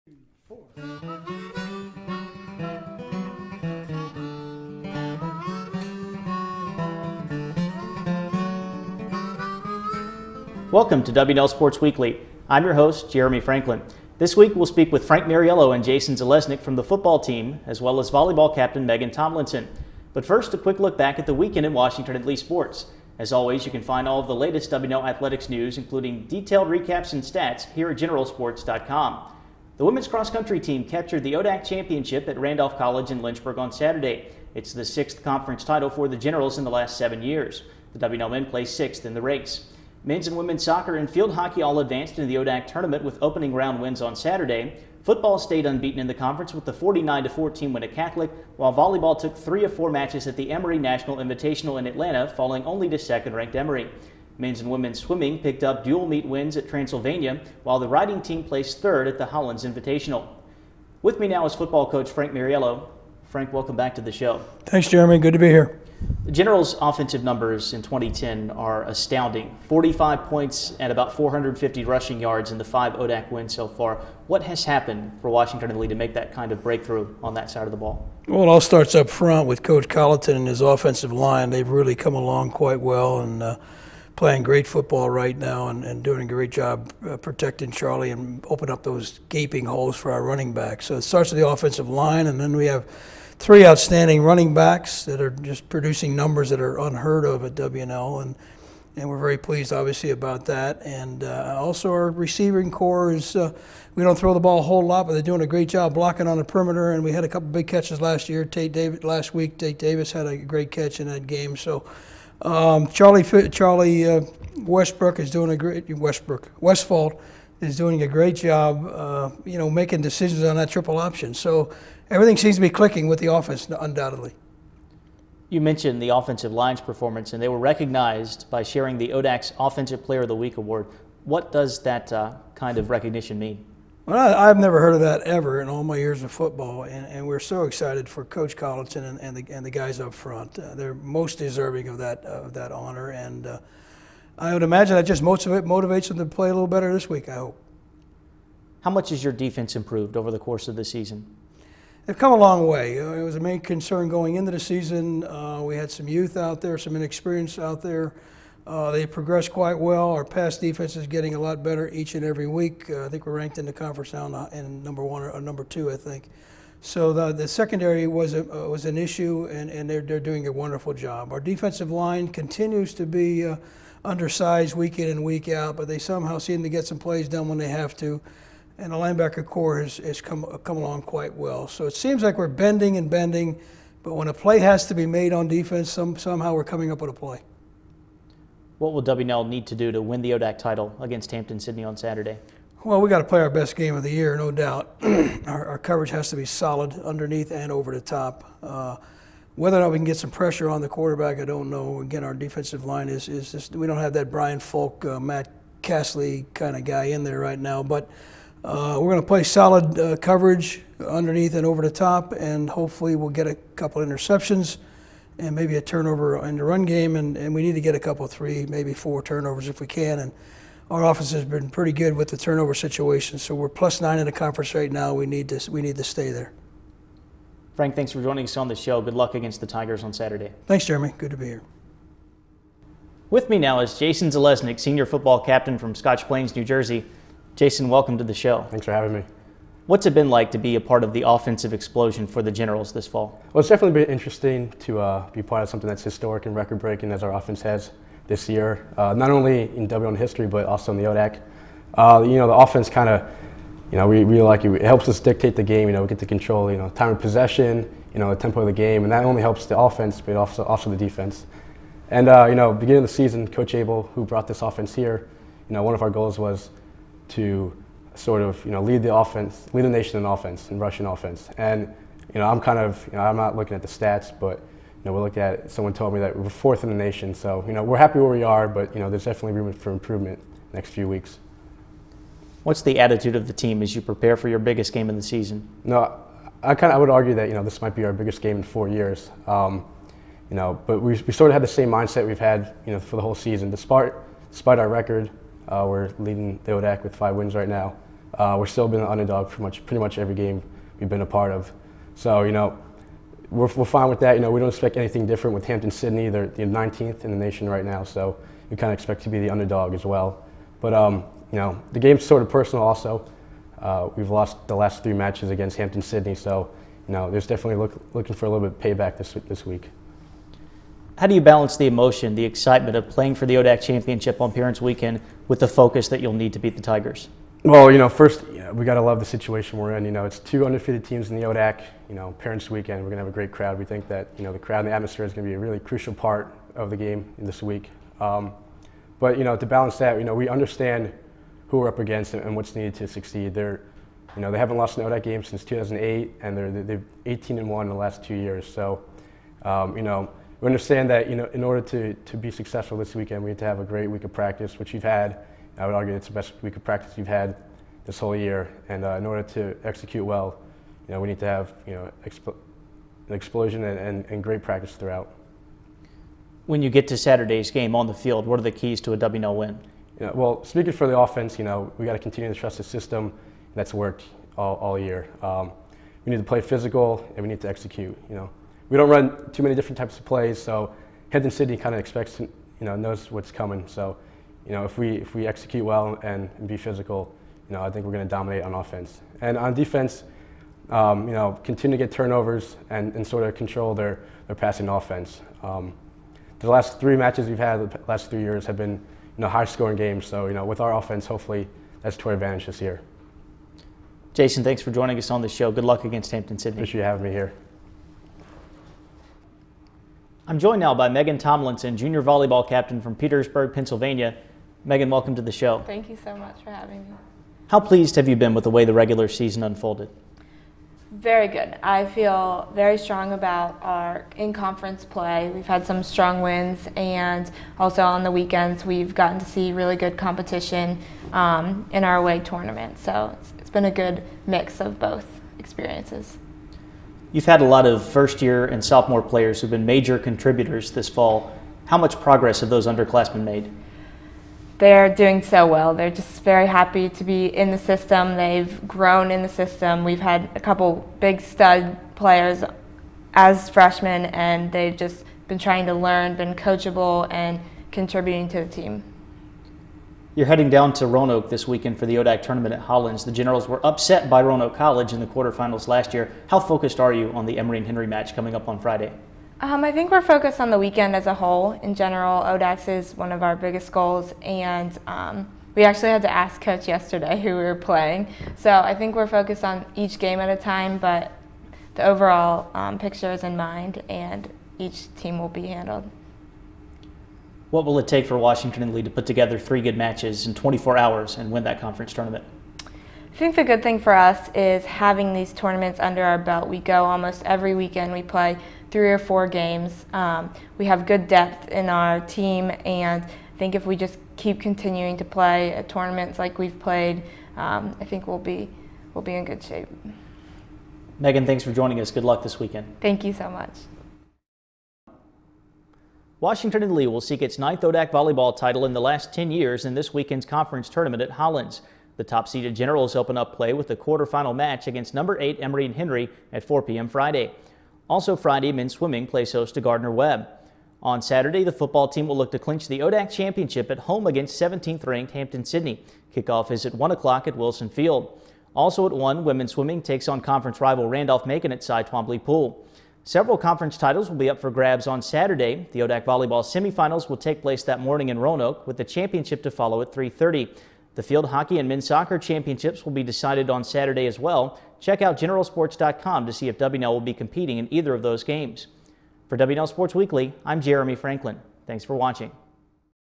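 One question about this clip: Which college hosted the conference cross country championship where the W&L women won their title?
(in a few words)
Randolph College.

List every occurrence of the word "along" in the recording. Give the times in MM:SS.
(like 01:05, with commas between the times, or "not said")
01:22, 03:00.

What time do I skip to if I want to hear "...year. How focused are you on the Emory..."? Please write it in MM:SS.
07:46.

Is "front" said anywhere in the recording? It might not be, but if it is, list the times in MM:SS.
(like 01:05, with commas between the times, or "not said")
01:19, 02:20.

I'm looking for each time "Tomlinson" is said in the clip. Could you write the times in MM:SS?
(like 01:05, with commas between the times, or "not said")
00:19, 06:51.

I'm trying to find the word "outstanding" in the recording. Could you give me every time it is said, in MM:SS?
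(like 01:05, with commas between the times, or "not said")
01:33.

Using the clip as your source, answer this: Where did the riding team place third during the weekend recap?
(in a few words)
Hollins Invitational.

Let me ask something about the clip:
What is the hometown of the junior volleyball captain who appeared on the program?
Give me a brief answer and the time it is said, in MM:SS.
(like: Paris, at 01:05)
Petersburg, Pennsylvania, at 06:53.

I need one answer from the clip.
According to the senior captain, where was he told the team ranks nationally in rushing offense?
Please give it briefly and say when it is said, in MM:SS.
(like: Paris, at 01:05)
fourth, at 04:36.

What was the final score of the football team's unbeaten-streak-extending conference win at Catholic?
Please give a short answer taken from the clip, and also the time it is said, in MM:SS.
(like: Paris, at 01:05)
49-14, at 00:46.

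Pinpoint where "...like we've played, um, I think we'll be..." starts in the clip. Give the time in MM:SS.
08:26.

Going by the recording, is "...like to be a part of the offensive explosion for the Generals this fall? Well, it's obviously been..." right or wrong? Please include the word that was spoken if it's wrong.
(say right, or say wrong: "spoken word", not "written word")
wrong: "definitely", not "obviously".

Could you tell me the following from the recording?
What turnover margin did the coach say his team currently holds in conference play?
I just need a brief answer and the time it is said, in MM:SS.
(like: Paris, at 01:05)
plus nine, at 03:43.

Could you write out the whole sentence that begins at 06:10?
You know, well, speaking for the offense, you know we got to continue to trust the system.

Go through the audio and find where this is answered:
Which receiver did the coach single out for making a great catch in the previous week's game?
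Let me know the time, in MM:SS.
01:49.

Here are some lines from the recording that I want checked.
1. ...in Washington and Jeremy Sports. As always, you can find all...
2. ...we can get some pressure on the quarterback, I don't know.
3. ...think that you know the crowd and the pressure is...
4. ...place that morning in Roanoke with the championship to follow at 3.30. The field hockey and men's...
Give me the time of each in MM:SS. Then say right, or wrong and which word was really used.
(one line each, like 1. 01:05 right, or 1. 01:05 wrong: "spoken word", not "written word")
1. 00:21 wrong: "Lee", not "Jeremy"
2. 03:19 right
3. 05:33 wrong: "atmosphere", not "pressure"
4. 09:07 right.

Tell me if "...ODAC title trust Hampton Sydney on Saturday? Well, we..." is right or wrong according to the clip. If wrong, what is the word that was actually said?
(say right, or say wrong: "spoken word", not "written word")
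wrong: "against", not "trust".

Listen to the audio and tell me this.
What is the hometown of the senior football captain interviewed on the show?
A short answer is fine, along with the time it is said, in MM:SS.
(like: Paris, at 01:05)
Scotch Plains, New Jersey, at 03:55.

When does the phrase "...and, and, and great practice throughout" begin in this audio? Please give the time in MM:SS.
06:03.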